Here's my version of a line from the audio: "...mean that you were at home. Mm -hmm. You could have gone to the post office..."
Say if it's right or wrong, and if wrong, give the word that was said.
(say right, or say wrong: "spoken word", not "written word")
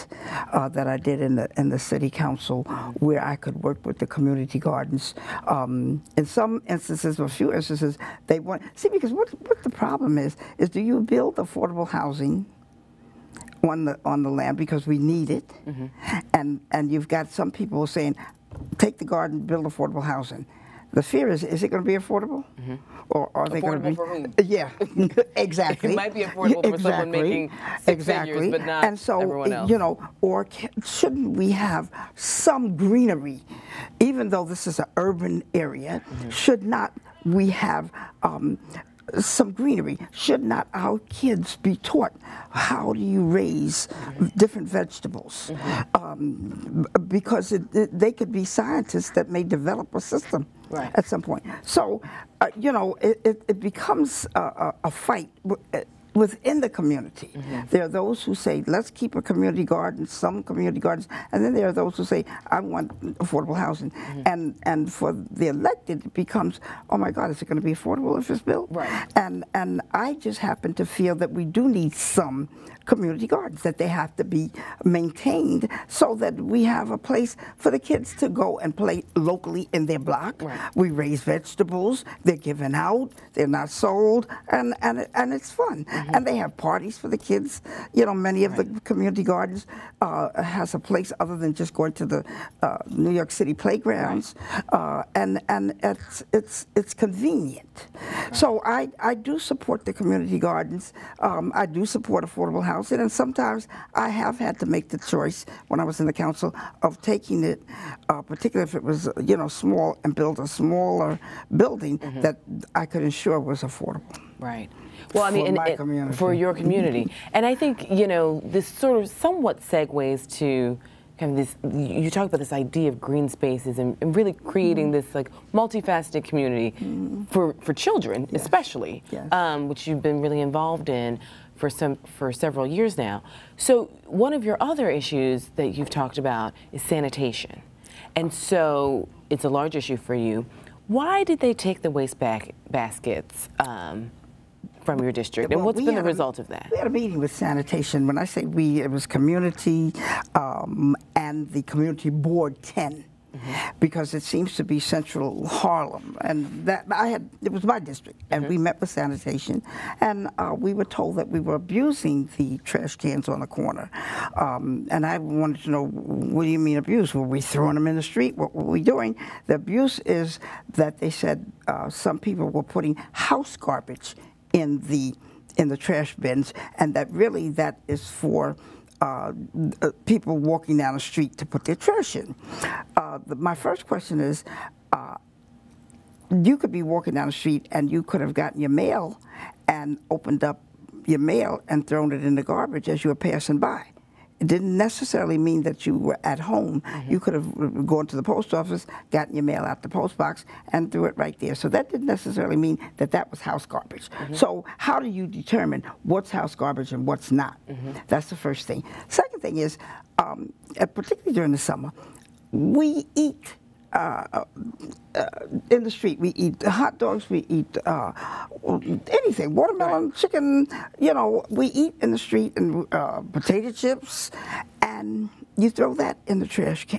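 right.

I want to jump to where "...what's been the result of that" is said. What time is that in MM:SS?
02:25.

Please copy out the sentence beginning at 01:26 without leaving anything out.
And they have parties for the kids.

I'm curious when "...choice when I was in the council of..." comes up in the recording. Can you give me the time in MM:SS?
01:44.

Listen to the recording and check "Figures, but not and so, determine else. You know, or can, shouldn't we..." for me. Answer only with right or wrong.
wrong.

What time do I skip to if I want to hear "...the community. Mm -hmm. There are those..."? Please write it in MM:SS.
00:56.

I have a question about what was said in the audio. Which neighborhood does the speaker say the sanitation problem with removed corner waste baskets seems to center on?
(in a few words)
Central Harlem.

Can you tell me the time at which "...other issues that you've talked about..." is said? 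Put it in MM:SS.
02:14.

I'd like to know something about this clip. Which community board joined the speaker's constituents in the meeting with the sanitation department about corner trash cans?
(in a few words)
Community Board 10.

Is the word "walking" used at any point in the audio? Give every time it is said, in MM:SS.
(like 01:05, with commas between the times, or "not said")
03:00, 03:06.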